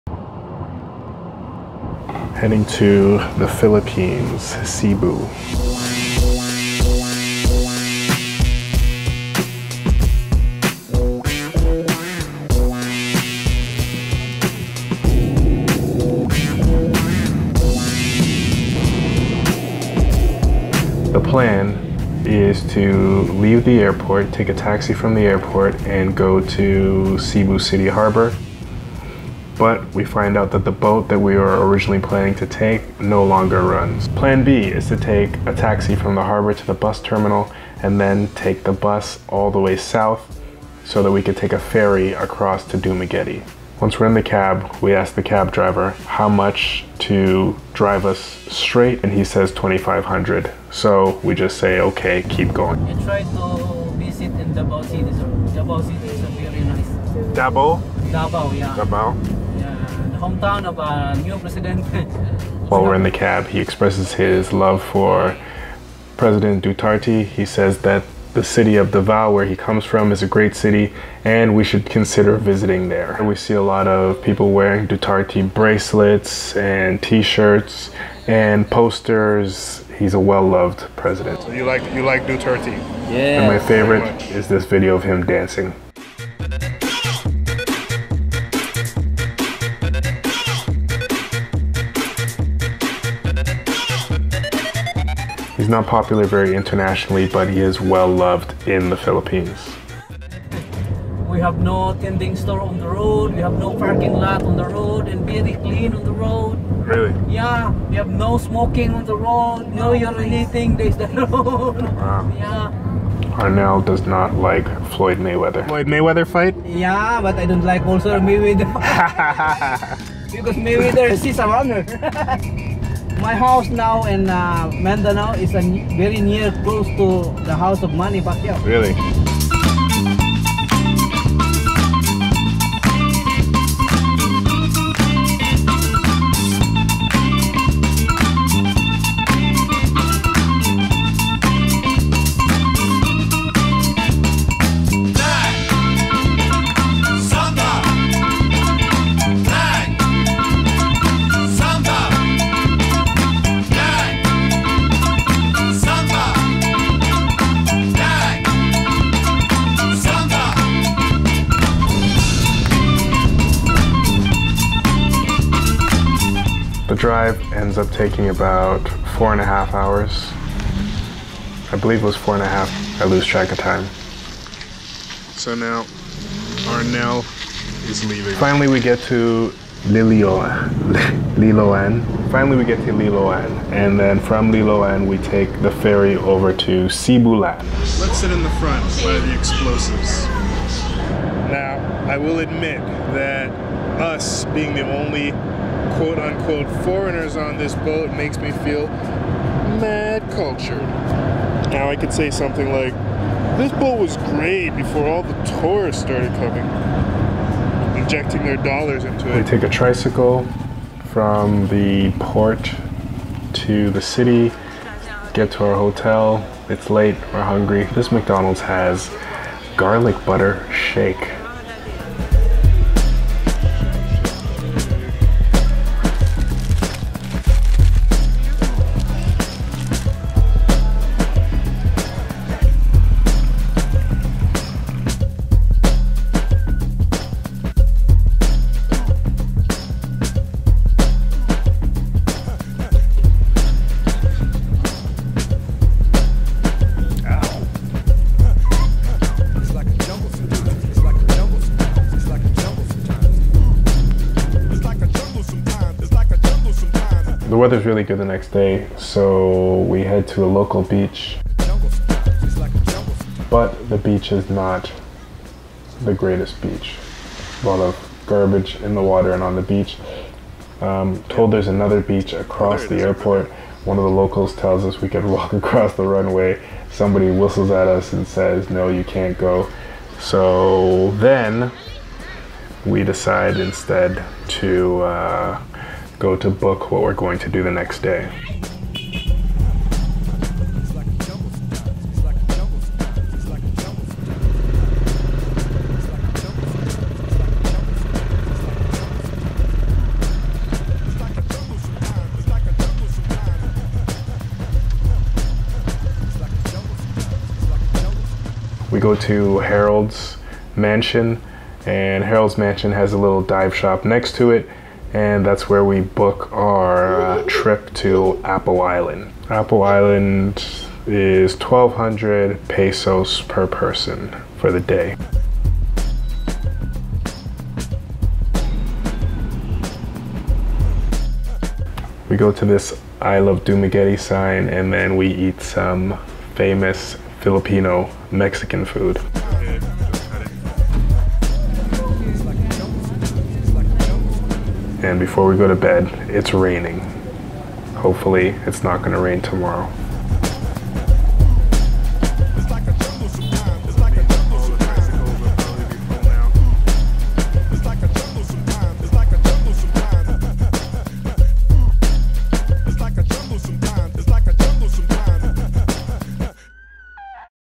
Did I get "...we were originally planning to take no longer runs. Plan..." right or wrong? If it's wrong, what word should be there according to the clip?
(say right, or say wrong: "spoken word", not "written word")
right.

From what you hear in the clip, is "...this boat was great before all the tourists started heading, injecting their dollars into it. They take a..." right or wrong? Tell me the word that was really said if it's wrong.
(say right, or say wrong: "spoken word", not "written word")
wrong: "coming", not "heading".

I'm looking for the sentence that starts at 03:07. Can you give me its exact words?
Let's sit in the front by the explosives.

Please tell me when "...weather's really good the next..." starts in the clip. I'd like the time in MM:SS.
04:17.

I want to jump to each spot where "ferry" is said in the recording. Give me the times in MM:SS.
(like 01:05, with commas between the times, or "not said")
00:41, 03:05.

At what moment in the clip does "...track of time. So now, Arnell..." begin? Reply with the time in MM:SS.
02:53.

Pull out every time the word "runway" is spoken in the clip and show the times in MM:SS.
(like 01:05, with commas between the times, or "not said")
04:36.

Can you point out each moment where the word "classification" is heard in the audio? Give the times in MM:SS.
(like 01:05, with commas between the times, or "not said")
not said.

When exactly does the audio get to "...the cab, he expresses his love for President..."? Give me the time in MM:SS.
01:03.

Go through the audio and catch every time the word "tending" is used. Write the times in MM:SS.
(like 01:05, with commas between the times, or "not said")
01:42.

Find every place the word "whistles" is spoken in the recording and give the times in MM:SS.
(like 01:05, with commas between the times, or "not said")
04:37.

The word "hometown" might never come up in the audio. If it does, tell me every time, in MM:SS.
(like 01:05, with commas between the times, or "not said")
01:00.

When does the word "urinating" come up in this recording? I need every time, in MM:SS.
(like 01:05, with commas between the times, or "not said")
01:49.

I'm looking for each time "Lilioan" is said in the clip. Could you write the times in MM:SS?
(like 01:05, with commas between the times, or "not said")
02:59.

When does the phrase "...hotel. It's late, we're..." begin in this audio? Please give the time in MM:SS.
03:35.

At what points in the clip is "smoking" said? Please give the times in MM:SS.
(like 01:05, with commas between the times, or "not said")
01:48.